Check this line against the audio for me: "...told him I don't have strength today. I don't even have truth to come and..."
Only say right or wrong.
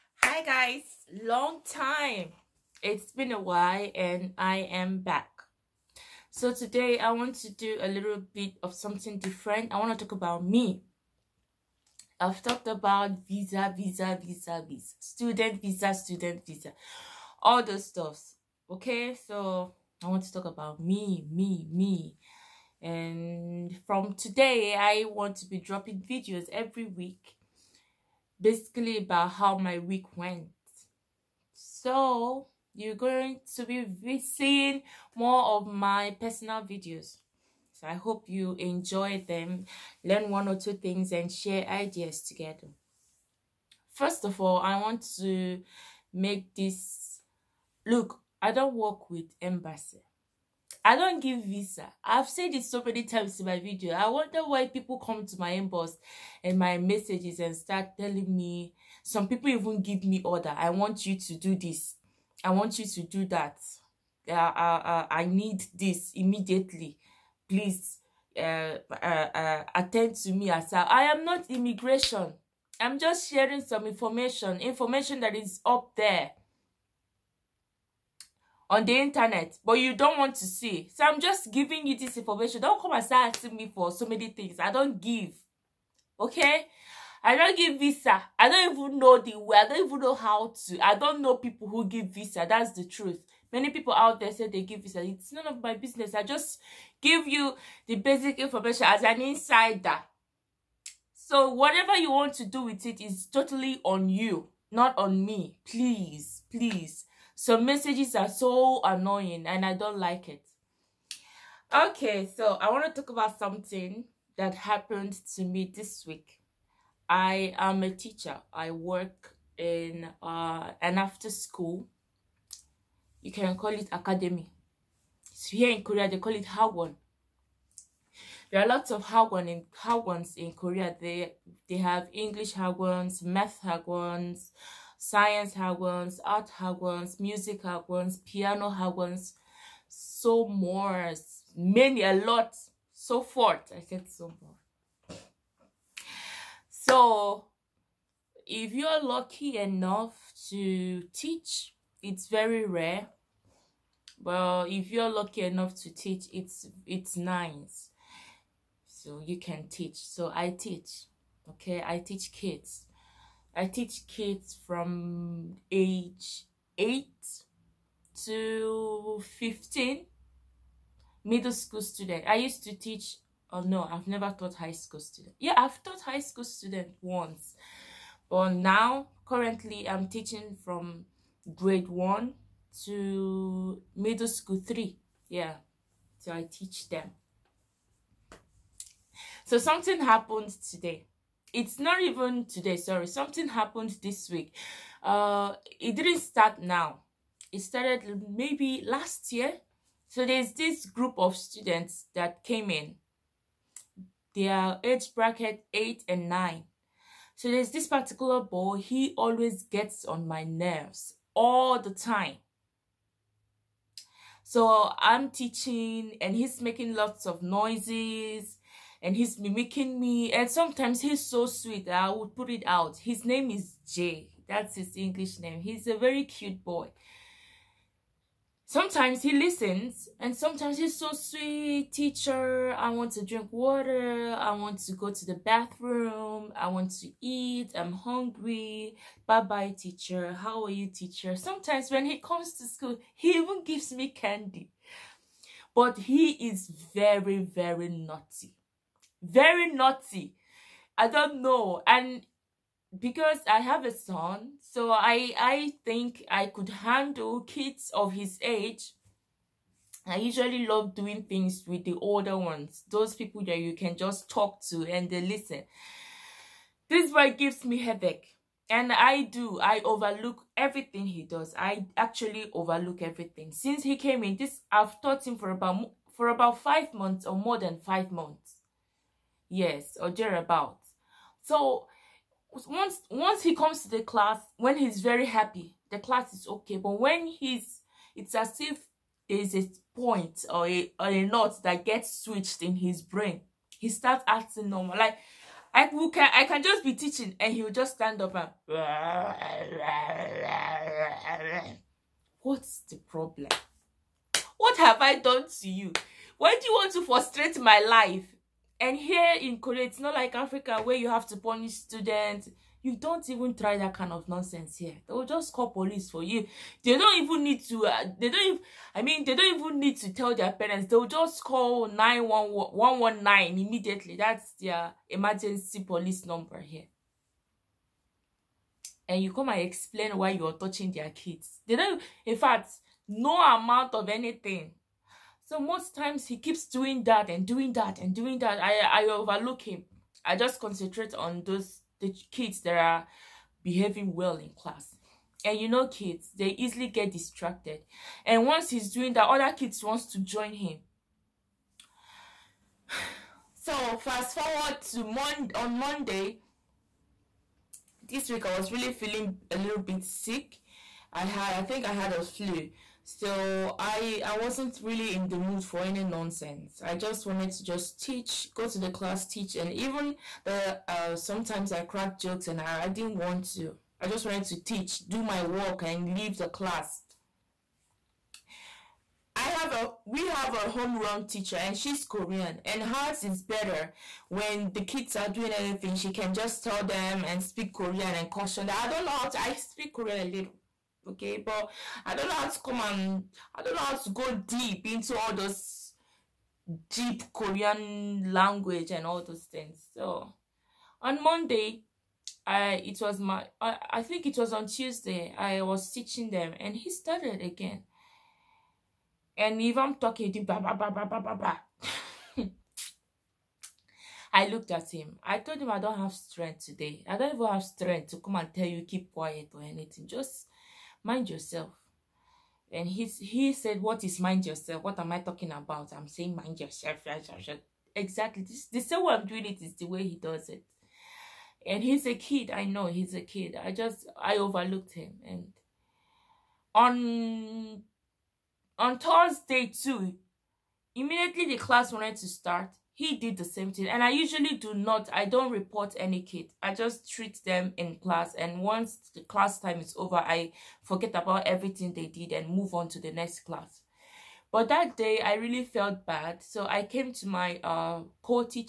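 wrong.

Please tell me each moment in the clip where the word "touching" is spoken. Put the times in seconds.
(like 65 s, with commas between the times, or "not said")
330 s.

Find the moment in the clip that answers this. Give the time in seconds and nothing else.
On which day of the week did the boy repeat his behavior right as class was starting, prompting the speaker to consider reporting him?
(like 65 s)
438 s.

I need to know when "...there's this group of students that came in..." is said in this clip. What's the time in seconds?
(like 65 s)
200 s.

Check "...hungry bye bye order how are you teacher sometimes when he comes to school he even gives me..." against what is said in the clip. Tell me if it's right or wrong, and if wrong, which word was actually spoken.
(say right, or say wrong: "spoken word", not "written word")
wrong: "teacher", not "order".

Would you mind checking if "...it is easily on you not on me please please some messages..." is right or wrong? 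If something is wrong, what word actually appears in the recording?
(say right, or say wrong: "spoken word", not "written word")
wrong: "totally", not "easily".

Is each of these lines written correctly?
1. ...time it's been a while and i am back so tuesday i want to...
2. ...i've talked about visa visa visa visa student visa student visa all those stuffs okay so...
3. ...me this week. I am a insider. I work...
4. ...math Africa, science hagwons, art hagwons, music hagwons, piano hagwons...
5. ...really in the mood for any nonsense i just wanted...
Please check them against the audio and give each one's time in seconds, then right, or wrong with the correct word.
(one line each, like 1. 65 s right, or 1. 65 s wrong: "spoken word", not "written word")
1. 1 s wrong: "today", not "tuesday"
2. 12 s right
3. 115 s wrong: "teacher", not "insider"
4. 133 s wrong: "Hagwons", not "Africa"
5. 364 s right.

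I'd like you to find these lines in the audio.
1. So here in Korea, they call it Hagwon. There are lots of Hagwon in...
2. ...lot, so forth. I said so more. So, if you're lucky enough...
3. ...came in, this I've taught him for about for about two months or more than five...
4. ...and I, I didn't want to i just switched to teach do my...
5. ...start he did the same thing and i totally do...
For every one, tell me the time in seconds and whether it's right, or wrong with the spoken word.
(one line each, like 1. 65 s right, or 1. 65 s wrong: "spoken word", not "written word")
1. 125 s right
2. 142 s right
3. 273 s wrong: "five", not "two"
4. 372 s wrong: "wanted", not "switched"
5. 442 s wrong: "usually", not "totally".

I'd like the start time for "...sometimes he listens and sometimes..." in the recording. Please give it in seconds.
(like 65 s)
228 s.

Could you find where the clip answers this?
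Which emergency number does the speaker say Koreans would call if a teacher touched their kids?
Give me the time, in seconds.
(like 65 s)
321 s.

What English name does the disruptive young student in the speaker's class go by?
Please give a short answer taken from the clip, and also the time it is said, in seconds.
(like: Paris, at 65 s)
Jay, at 223 s.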